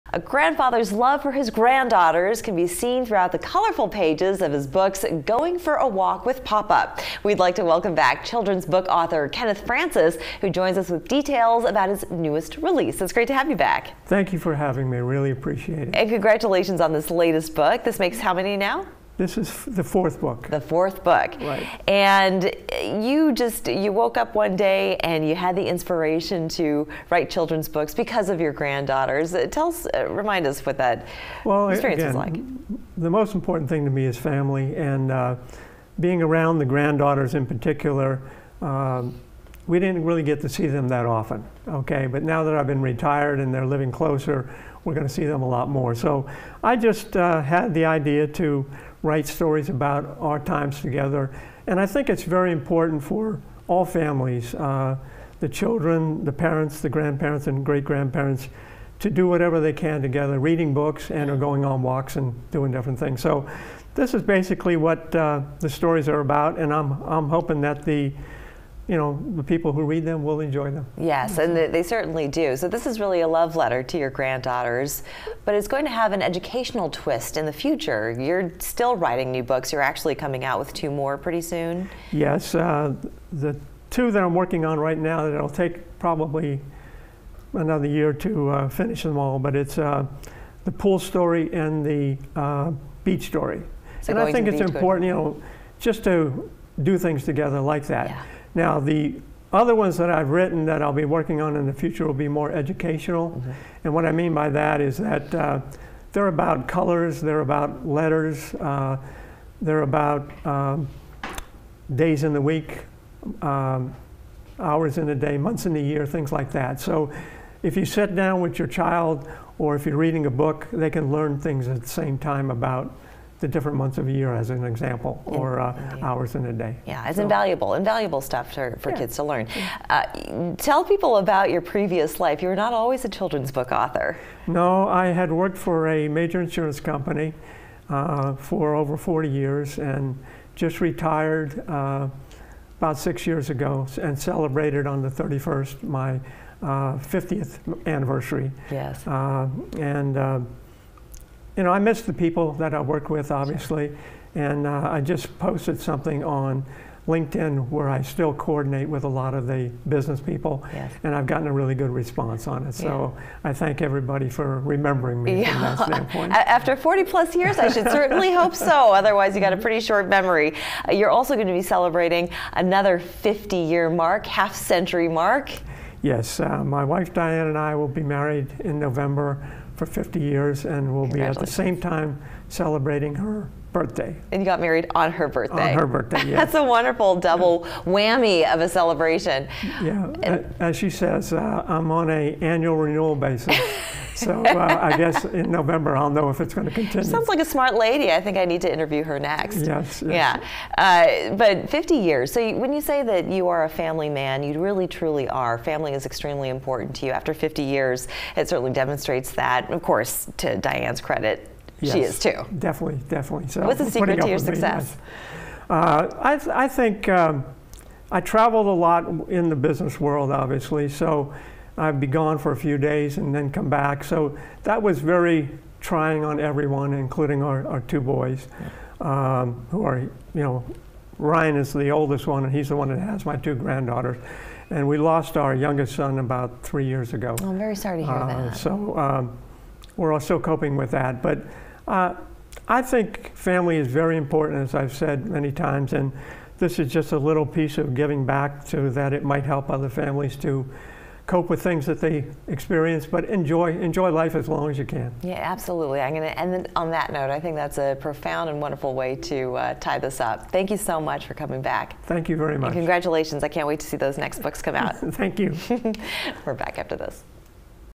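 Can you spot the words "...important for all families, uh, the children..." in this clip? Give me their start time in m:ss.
0:52.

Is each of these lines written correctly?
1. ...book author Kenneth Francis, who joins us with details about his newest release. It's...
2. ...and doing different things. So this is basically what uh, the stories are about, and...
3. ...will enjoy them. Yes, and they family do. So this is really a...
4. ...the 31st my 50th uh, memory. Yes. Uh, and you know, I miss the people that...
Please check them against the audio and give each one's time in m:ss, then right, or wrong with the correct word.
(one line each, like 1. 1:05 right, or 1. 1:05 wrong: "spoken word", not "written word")
1. 0:08 right
2. 1:02 right
3. 1:10 wrong: "certainly", not "family"
4. 2:25 wrong: "anniversary", not "memory".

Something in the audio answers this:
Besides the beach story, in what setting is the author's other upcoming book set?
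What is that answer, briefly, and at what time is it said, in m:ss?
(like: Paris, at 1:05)
pool, at 1:30.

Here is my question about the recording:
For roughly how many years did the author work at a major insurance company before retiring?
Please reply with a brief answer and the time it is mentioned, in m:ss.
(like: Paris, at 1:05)
over 40 years, at 2:18.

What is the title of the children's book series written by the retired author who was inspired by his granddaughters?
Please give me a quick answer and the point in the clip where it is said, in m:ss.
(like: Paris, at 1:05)
Going for a Walk with Papa, at 0:05.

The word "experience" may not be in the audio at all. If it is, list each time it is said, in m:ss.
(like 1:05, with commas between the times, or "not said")
0:31, 4:12.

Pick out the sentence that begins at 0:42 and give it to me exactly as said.
But now that I've been retired and they're living closer, we're going to see them a lot more.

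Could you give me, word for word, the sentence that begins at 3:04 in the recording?
And you got married on her birthday.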